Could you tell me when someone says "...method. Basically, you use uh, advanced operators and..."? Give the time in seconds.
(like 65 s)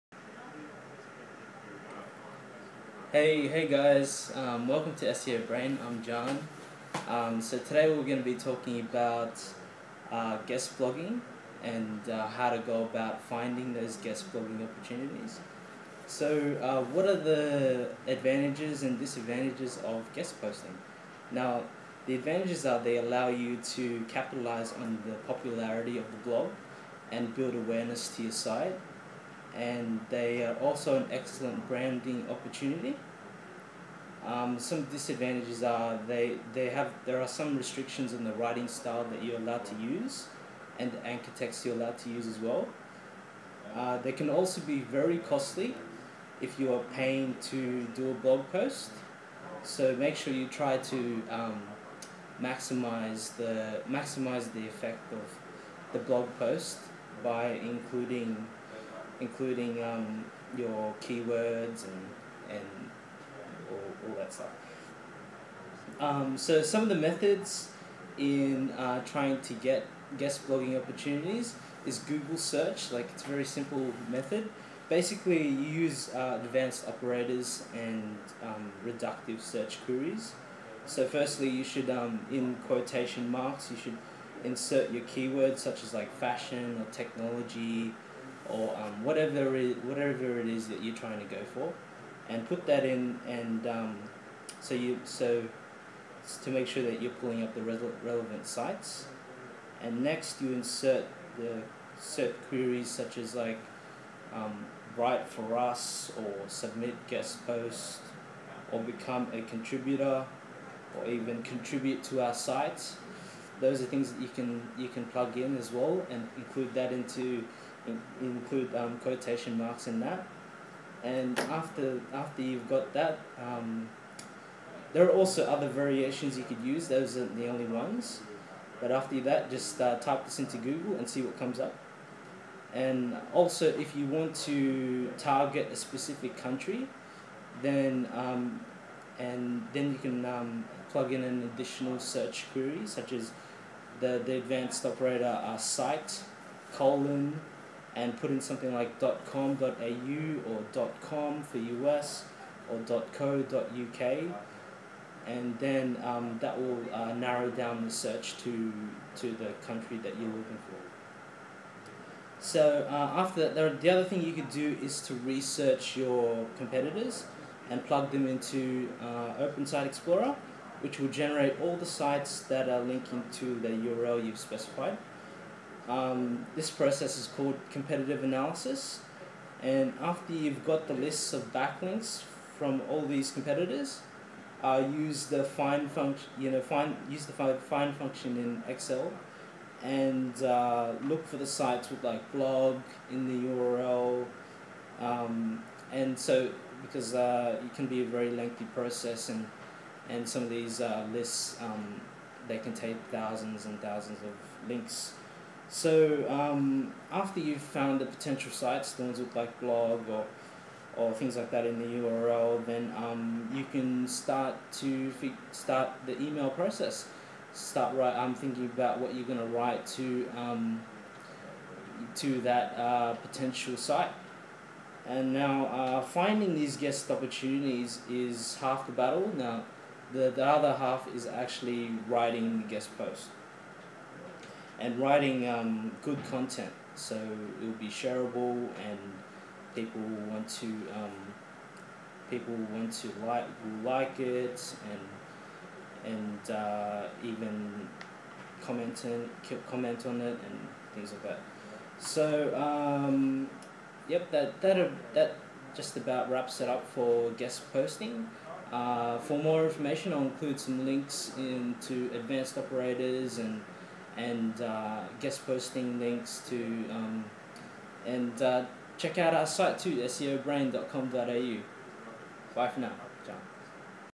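74 s.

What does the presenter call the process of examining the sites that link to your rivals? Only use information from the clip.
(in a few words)
competitive analysis.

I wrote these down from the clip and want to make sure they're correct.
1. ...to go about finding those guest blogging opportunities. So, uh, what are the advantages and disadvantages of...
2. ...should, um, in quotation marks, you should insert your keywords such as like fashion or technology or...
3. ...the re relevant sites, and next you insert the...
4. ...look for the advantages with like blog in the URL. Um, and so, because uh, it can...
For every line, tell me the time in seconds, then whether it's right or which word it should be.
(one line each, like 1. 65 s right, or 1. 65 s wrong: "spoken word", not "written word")
1. 12 s right
2. 81 s right
3. 97 s right
4. 191 s wrong: "sites", not "advantages".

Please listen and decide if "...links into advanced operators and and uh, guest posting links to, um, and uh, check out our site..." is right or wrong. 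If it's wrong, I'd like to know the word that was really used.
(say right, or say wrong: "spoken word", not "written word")
right.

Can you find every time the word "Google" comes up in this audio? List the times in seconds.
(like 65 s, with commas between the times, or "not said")
71 s, 130 s.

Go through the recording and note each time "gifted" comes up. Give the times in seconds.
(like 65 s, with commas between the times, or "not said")
not said.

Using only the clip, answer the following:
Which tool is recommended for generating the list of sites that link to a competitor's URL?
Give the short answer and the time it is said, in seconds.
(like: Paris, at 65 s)
Open Site Explorer, at 169 s.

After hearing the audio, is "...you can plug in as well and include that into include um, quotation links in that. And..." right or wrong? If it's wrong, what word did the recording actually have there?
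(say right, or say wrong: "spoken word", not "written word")
wrong: "marks", not "links".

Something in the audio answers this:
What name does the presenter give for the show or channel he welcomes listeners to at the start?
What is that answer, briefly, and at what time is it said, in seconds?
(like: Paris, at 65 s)
SEO Brain, at 5 s.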